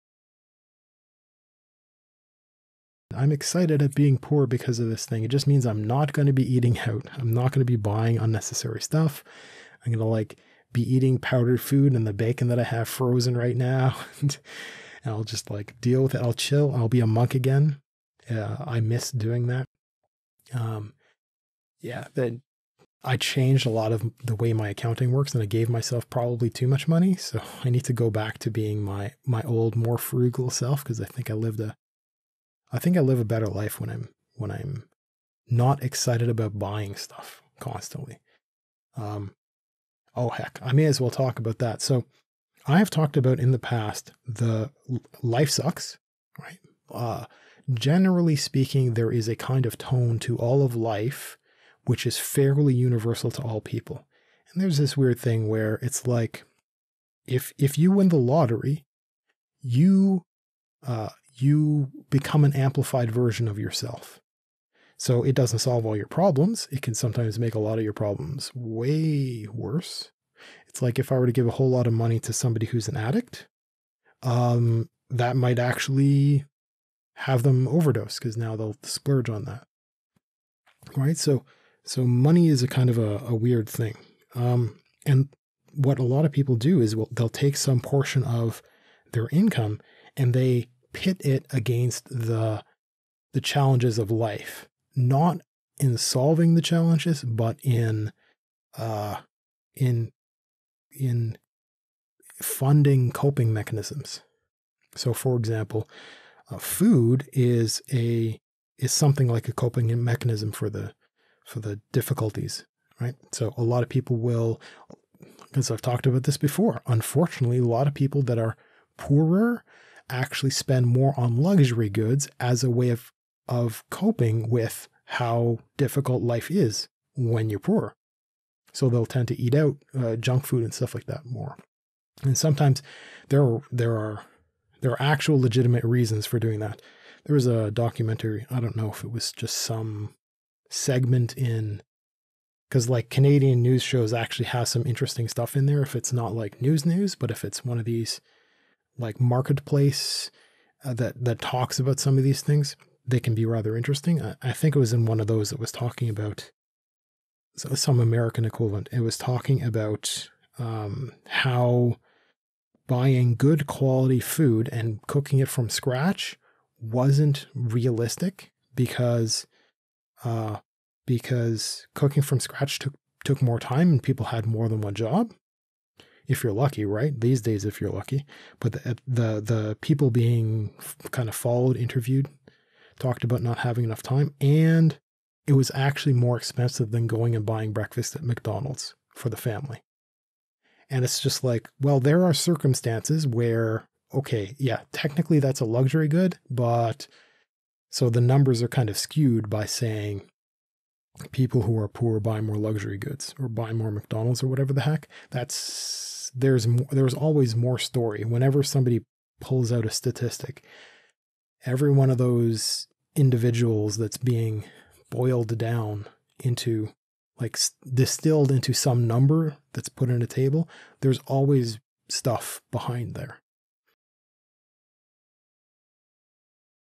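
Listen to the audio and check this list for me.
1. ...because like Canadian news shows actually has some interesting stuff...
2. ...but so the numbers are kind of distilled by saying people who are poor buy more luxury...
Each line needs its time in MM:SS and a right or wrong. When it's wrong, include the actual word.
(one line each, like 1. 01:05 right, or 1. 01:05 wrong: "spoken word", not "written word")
1. 02:22 right
2. 03:16 wrong: "skewed", not "distilled".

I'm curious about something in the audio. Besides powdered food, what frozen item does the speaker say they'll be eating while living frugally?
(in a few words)
bacon.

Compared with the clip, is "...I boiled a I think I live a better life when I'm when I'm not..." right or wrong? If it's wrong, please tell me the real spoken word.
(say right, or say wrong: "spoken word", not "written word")
wrong: "lived", not "boiled".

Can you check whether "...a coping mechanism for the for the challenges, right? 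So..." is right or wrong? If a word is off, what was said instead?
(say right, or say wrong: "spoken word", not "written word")
wrong: "difficulties", not "challenges".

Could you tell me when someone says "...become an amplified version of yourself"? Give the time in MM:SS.
01:02.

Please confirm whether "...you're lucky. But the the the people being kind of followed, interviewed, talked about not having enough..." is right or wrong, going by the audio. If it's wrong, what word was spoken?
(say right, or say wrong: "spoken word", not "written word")
right.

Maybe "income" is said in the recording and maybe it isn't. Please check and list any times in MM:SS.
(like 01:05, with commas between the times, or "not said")
01:29.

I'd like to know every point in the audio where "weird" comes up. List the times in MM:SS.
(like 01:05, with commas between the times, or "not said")
00:54, 01:23.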